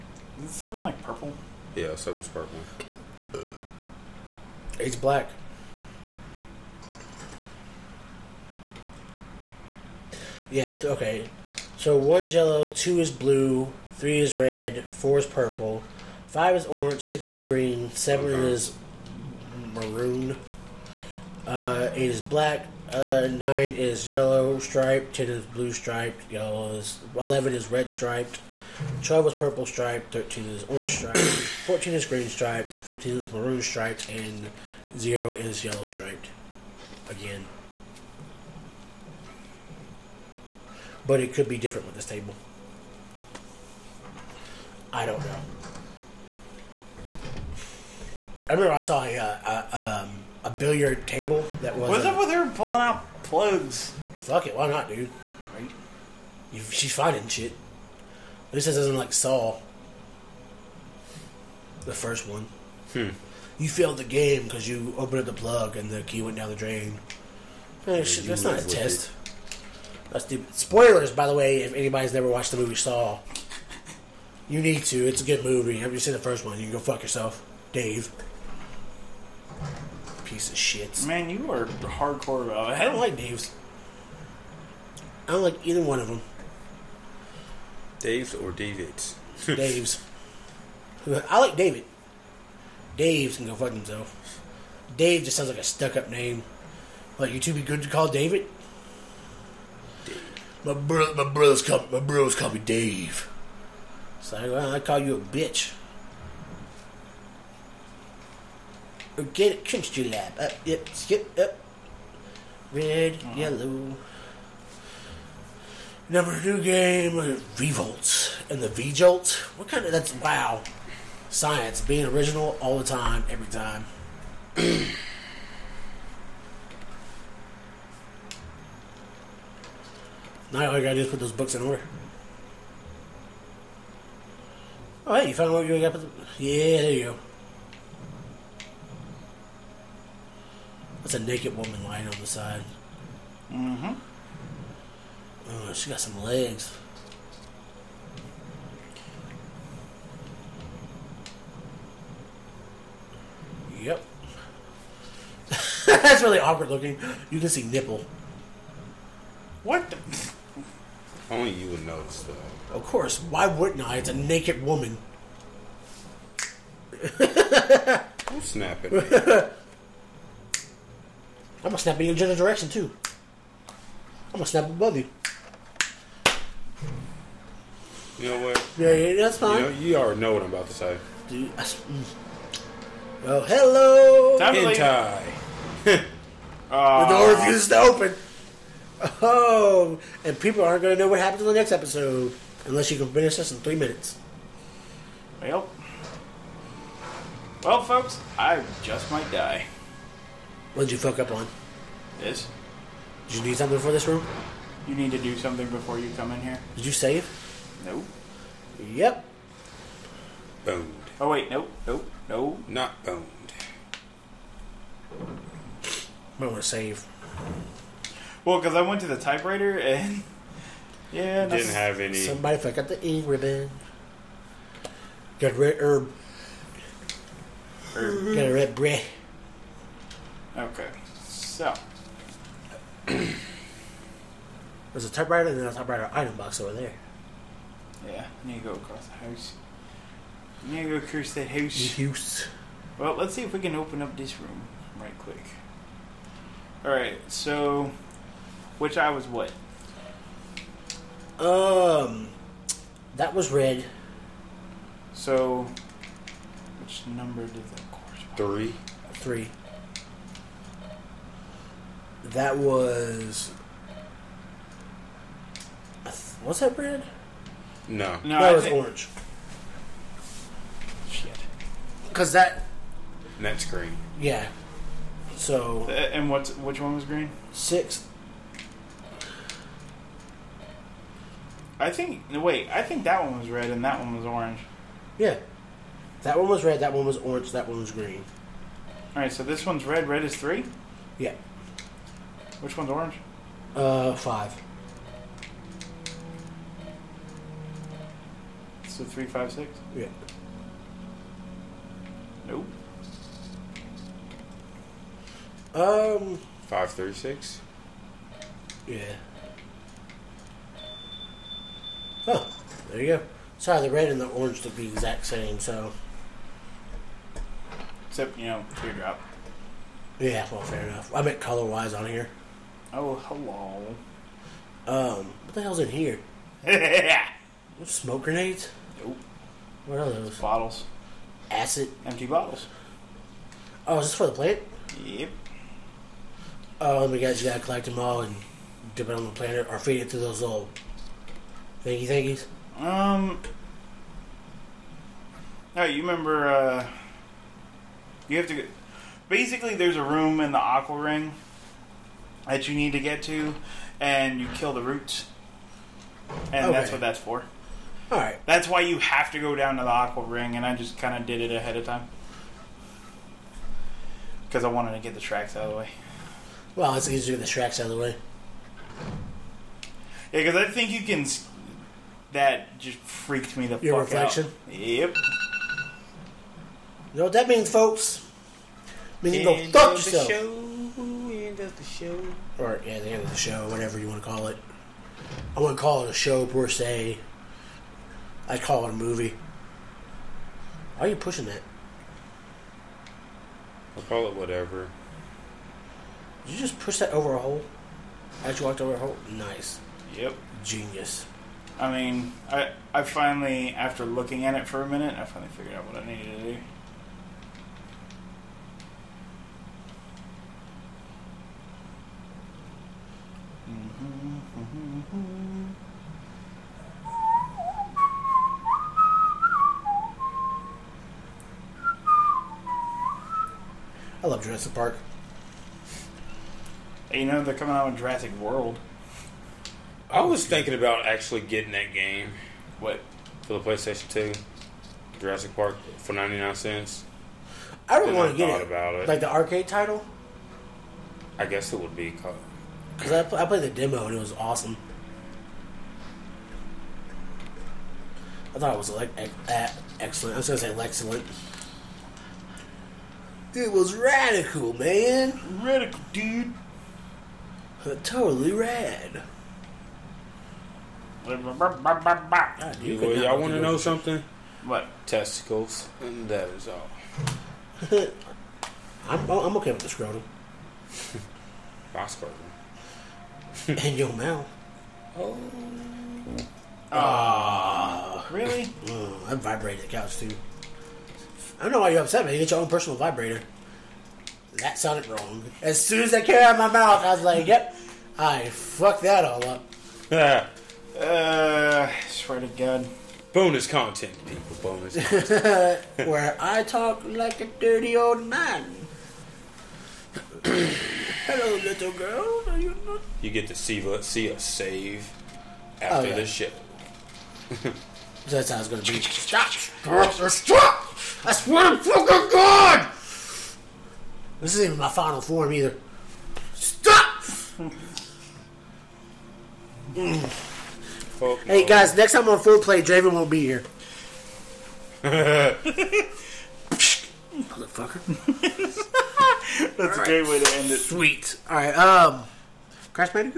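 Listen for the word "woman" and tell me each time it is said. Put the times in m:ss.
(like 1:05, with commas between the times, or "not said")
2:21, 2:44.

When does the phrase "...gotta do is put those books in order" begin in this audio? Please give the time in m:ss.
2:10.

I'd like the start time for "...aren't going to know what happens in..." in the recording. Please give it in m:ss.
3:10.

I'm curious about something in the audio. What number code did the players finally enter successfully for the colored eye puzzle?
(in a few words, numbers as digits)
5, 3, 6.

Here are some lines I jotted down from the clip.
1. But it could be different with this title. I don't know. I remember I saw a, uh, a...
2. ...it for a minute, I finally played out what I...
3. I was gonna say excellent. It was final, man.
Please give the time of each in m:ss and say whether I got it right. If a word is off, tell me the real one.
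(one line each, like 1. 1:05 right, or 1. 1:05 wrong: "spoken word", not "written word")
1. 0:41 wrong: "table", not "title"
2. 6:44 wrong: "figured", not "played"
3. 7:30 wrong: "radical", not "final".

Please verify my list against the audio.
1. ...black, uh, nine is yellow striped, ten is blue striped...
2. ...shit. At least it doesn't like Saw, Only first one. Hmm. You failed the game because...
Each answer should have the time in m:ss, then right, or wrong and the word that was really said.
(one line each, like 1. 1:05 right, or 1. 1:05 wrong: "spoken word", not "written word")
1. 0:22 right
2. 0:57 wrong: "The", not "Only".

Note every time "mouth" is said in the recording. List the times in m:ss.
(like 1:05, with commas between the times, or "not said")
7:54, 8:06.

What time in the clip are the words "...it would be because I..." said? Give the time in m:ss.
7:21.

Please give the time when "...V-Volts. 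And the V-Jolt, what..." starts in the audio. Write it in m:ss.
1:57.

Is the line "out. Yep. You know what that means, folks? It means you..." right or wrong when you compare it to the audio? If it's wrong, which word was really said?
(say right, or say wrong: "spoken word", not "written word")
right.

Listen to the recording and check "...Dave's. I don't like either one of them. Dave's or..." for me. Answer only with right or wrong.
right.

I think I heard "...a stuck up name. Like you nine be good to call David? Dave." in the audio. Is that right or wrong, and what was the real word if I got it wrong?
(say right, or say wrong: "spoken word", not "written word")
wrong: "two", not "nine".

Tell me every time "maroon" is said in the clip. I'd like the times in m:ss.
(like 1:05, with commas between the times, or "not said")
0:19, 0:33.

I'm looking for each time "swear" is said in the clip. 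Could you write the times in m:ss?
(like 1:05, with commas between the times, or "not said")
8:12, 8:31.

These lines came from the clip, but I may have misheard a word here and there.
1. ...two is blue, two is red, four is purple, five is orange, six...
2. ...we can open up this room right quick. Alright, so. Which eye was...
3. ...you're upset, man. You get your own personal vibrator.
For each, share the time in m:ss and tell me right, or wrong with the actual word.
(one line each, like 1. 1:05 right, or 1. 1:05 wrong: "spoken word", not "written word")
1. 0:12 wrong: "three", not "two"
2. 4:03 right
3. 8:01 right.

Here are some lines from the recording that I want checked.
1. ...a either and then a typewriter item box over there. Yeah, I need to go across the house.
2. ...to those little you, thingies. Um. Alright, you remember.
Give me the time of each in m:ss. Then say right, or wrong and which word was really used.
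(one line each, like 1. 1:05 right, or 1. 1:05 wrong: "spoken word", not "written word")
1. 3:55 wrong: "typewriter", not "either"
2. 5:40 right.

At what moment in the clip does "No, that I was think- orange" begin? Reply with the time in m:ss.
4:28.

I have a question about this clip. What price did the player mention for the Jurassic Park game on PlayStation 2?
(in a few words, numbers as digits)
99 cents.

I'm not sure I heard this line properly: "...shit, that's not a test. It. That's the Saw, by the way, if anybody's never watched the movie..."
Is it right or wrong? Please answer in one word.
wrong.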